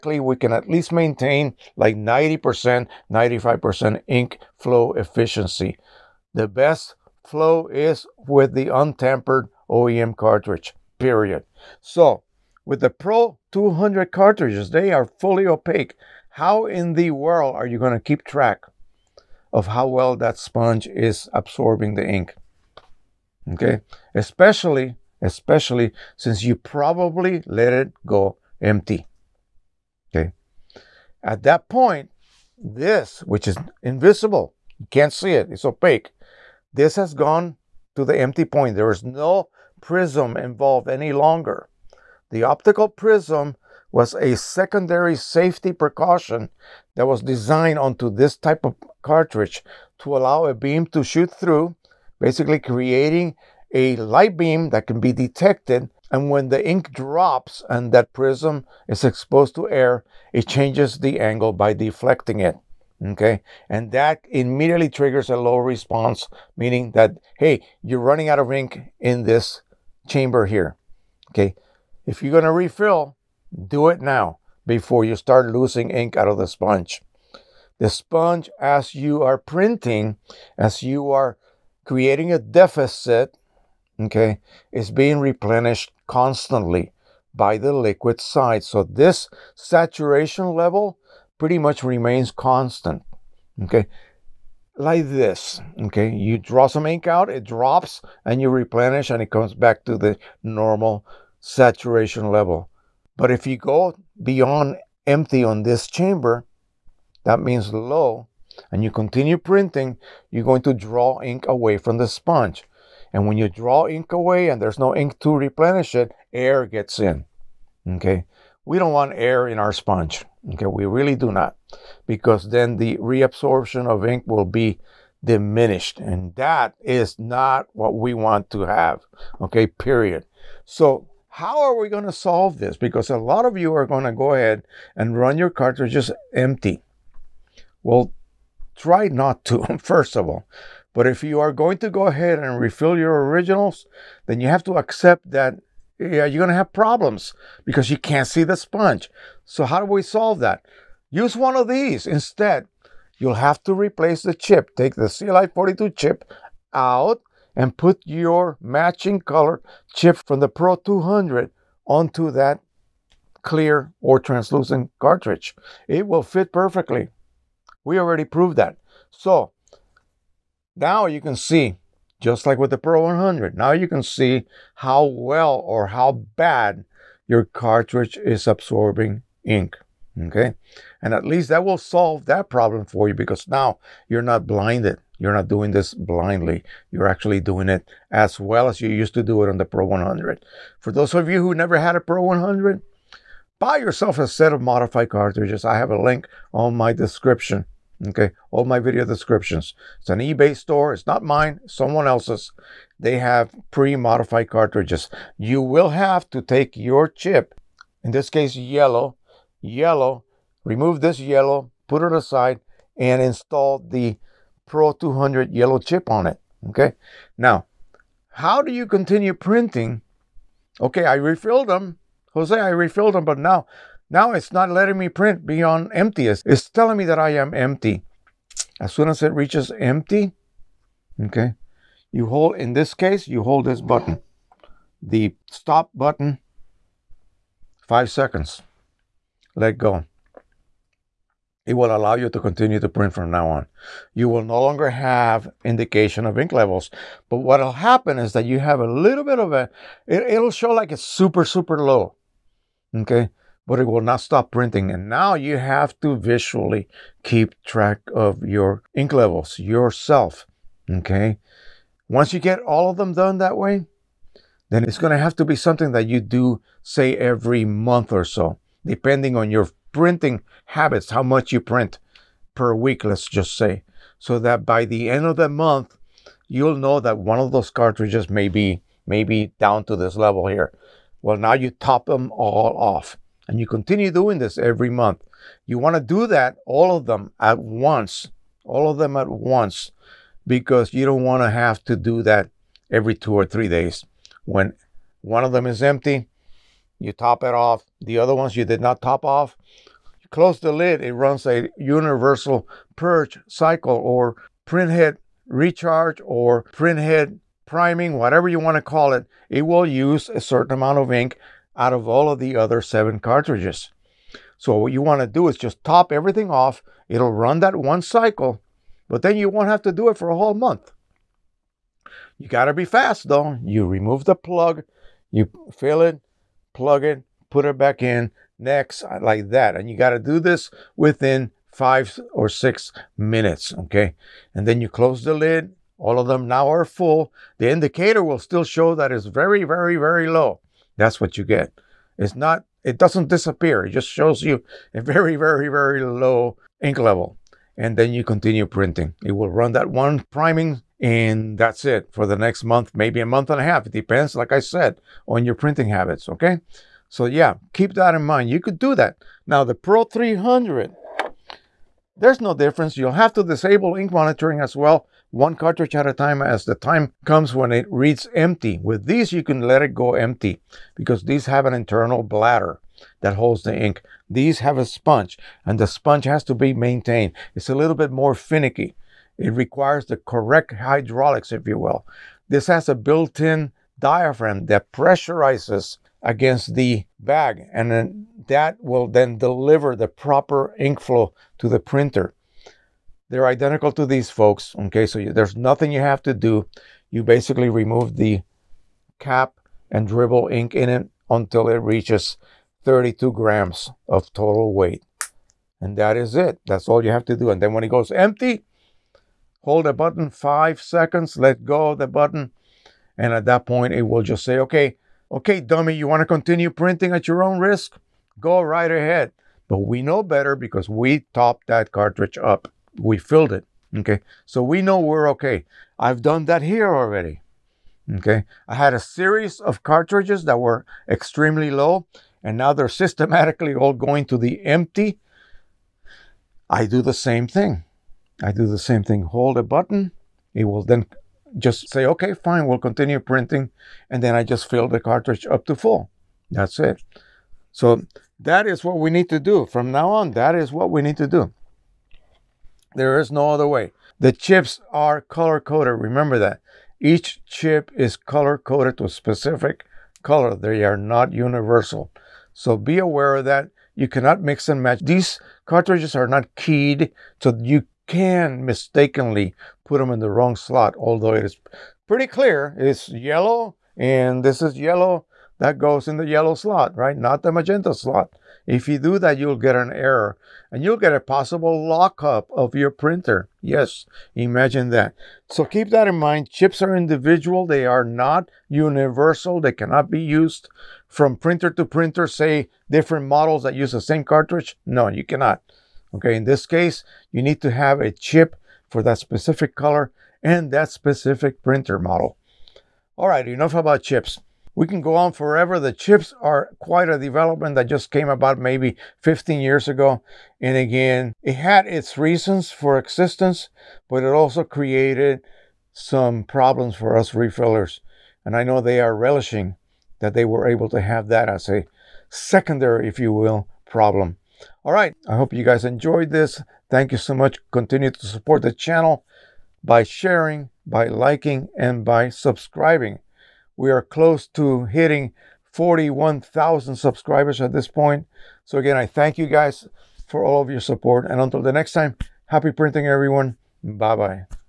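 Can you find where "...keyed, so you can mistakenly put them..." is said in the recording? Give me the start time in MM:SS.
07:46.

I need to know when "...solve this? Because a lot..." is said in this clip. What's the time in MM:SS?
02:12.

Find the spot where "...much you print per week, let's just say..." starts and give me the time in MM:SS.
04:31.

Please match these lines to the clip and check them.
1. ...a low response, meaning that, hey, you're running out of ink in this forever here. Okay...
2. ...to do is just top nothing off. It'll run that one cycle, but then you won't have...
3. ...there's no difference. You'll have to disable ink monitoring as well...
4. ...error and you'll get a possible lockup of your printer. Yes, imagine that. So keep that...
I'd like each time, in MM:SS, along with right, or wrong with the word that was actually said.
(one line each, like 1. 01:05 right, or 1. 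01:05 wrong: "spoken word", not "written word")
1. 01:05 wrong: "chamber", not "forever"
2. 05:15 wrong: "everything", not "nothing"
3. 06:02 right
4. 07:59 right.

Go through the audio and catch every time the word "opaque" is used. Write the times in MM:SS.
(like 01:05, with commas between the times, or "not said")
00:15, 00:35.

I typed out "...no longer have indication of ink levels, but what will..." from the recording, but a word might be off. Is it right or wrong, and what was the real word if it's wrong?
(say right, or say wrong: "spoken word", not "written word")
right.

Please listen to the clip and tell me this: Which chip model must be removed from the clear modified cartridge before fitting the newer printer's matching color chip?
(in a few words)
CLI 42.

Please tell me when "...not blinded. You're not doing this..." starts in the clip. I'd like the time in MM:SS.
03:04.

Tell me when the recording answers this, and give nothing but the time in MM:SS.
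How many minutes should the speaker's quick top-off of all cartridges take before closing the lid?
05:31.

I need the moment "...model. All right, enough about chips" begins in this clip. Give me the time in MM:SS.
08:21.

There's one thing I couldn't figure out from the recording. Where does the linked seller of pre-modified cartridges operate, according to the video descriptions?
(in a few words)
eBay store.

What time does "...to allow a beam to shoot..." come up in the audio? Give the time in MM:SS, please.
00:49.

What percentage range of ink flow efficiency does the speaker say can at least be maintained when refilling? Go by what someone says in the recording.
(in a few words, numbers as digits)
90%, 95%.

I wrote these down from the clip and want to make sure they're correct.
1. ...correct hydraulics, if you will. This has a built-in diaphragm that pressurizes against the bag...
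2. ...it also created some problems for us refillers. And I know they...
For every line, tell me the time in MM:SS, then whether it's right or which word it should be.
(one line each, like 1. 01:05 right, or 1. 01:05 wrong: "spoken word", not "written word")
1. 06:20 right
2. 08:34 right.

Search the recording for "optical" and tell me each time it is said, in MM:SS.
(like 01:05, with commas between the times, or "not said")
00:42.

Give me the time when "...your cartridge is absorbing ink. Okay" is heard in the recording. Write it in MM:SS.
02:57.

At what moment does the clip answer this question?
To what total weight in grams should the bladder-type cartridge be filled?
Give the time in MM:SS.
06:42.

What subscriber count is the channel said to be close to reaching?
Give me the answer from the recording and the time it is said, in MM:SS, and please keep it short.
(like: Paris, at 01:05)
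41,000, at 08:55.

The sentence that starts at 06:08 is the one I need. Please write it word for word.
With these, you can let it go empty because these have an internal bladder that holds the ink.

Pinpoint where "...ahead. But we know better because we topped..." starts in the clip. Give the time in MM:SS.
06:58.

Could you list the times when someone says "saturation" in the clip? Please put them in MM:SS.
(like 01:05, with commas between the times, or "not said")
01:29, 01:41.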